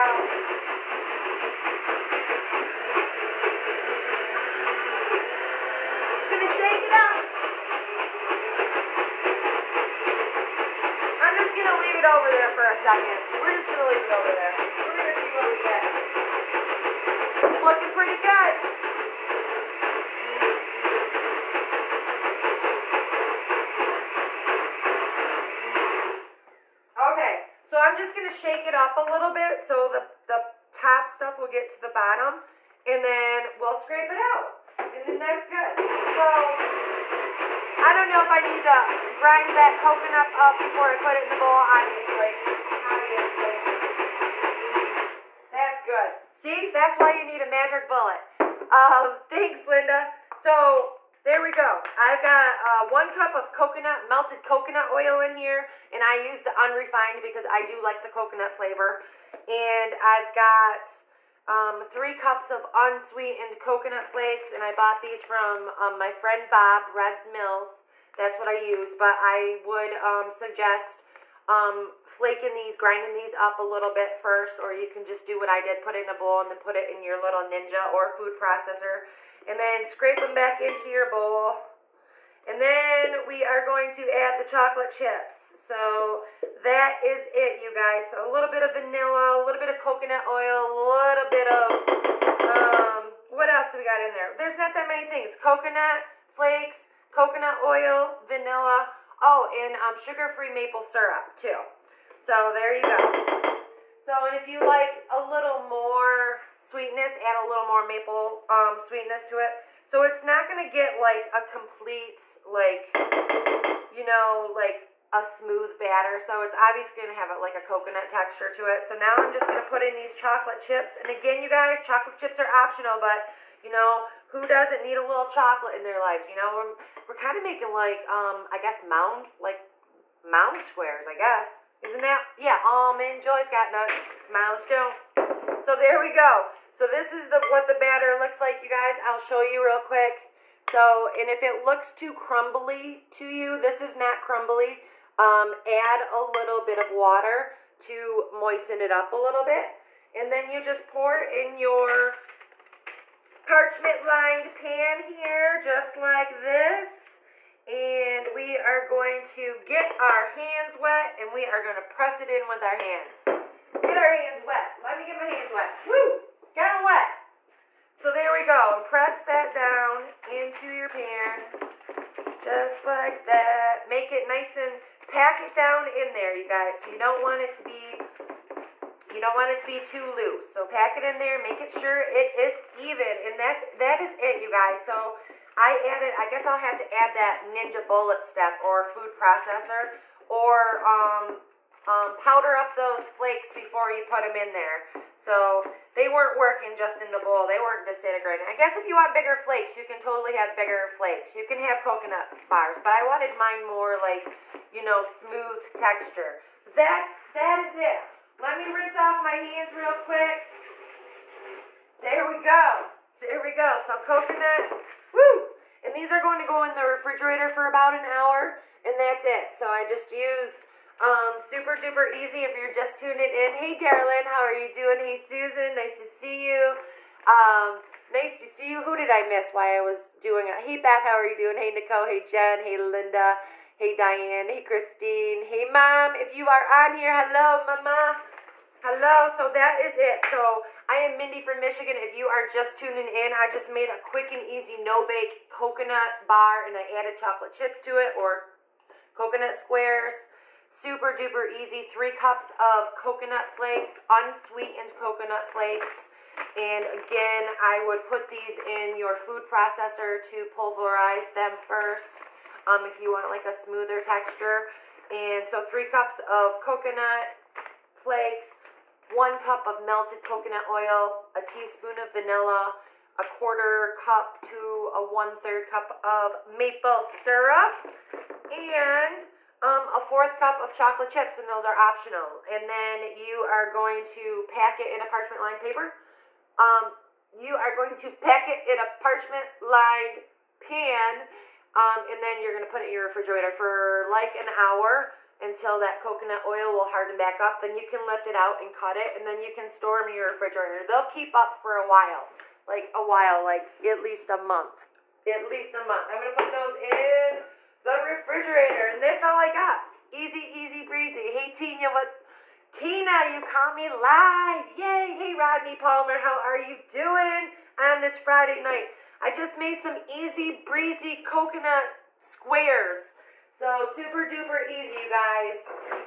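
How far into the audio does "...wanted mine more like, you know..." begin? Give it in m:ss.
3:23.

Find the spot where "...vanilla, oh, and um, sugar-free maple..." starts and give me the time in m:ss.
1:38.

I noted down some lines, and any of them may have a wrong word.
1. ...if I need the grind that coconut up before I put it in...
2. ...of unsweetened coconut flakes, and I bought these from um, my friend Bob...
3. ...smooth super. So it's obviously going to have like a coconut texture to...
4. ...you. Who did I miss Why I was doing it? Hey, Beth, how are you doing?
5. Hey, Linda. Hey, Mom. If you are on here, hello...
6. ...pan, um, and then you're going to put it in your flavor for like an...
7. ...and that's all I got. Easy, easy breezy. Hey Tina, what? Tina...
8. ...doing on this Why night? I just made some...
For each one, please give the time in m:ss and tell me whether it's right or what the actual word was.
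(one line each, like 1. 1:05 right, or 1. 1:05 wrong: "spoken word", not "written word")
1. 0:38 right
2. 1:02 right
3. 1:55 wrong: "batter", not "super"
4. 3:48 right
5. 3:54 wrong: "Christine", not "Linda"
6. 4:50 wrong: "refrigerator", not "flavor"
7. 5:08 right
8. 5:16 wrong: "Friday", not "Why".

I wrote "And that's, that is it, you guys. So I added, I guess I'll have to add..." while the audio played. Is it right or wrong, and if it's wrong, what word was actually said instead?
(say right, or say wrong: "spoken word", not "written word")
right.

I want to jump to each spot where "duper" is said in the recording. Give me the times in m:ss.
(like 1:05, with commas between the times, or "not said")
3:41, 4:11, 5:24.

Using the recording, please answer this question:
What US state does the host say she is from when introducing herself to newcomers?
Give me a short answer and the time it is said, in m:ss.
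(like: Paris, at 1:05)
Michigan, at 4:01.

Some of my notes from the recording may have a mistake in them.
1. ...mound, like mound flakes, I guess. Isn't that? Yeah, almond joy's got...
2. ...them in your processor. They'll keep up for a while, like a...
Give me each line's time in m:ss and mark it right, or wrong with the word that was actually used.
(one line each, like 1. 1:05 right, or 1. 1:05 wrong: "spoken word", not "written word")
1. 2:08 wrong: "squares", not "flakes"
2. 4:59 wrong: "refrigerator", not "processor".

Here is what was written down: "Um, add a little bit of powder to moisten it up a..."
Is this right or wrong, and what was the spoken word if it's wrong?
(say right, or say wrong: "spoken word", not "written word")
wrong: "water", not "powder".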